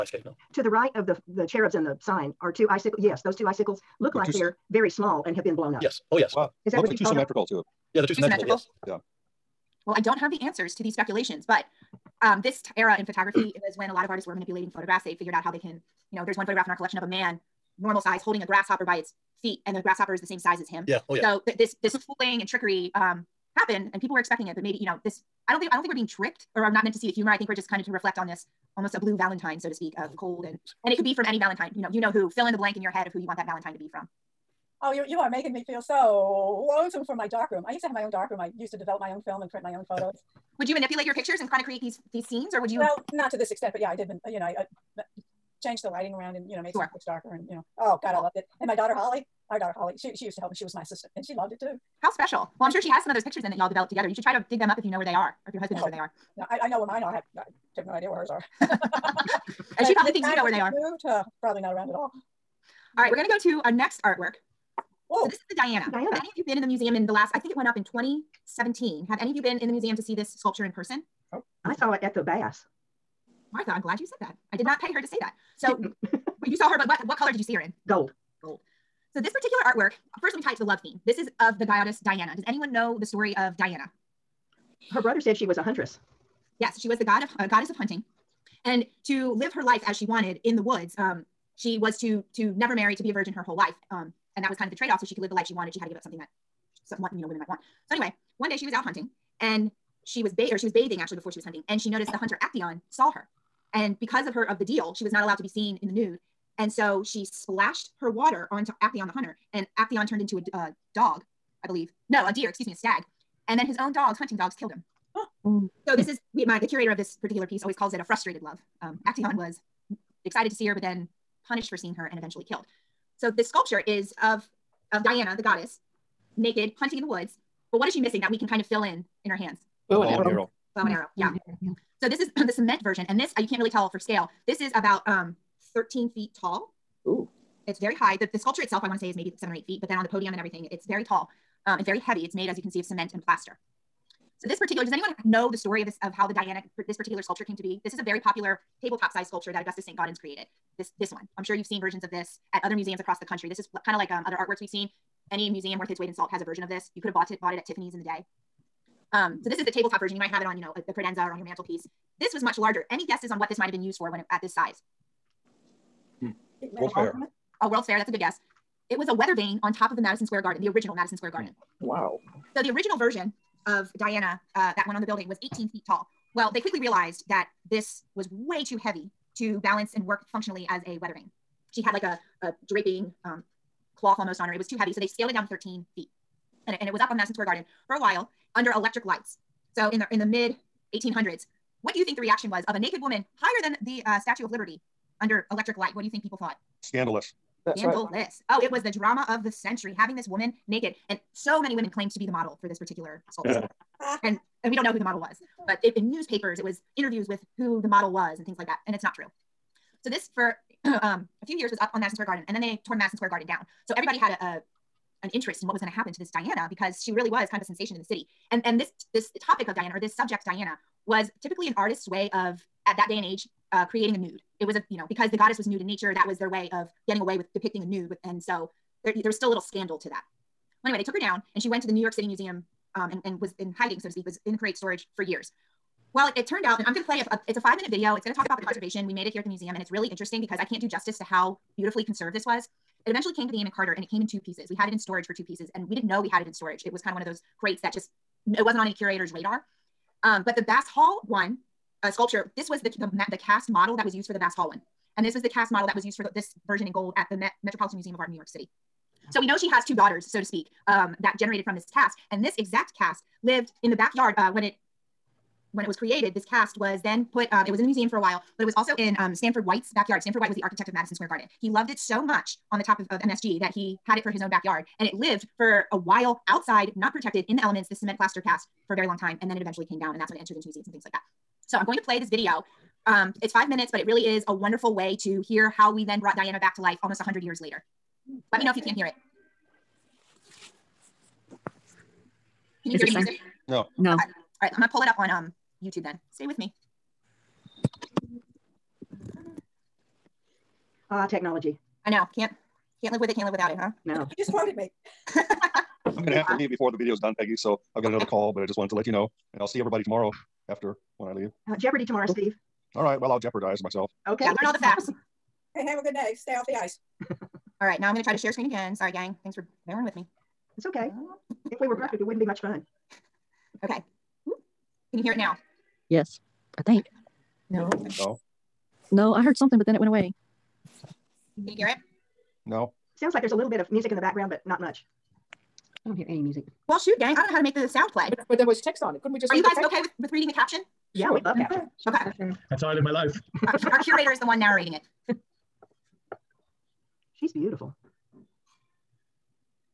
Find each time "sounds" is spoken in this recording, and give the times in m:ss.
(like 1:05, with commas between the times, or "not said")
5:33, 5:37.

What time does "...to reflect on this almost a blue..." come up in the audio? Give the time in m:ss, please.
0:27.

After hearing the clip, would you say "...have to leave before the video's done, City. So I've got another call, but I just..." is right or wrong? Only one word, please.
wrong.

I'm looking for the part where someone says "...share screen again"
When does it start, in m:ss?
5:18.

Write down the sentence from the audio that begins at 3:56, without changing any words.
Well, it, it, turned out, and I'm going to play a, a, it's a five minute video.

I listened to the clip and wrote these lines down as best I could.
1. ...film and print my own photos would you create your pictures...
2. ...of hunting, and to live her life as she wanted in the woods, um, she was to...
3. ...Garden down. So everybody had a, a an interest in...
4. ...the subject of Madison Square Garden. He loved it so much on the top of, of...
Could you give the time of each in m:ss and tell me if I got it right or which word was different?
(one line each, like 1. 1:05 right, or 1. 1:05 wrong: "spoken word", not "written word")
1. 0:39 wrong: "manipulate", not "create"
2. 1:27 right
3. 3:33 right
4. 4:30 wrong: "architect", not "subject".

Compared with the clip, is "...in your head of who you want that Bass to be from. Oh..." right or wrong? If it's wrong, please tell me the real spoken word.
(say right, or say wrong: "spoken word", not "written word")
wrong: "Valentine", not "Bass".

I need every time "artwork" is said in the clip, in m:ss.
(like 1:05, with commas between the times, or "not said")
1:04, 1:19, 2:34.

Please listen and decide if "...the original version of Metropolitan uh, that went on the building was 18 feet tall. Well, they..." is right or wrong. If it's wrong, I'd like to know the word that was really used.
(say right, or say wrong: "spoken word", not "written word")
wrong: "Diana", not "Metropolitan".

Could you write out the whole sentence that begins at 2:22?
It's made, as you can see, of cement and plaster.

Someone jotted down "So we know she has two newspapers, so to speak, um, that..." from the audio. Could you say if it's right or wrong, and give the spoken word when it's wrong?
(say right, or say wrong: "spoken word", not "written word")
wrong: "daughters", not "newspapers".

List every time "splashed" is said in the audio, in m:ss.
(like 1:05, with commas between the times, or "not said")
1:47.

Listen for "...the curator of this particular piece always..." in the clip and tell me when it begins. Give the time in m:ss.
1:56.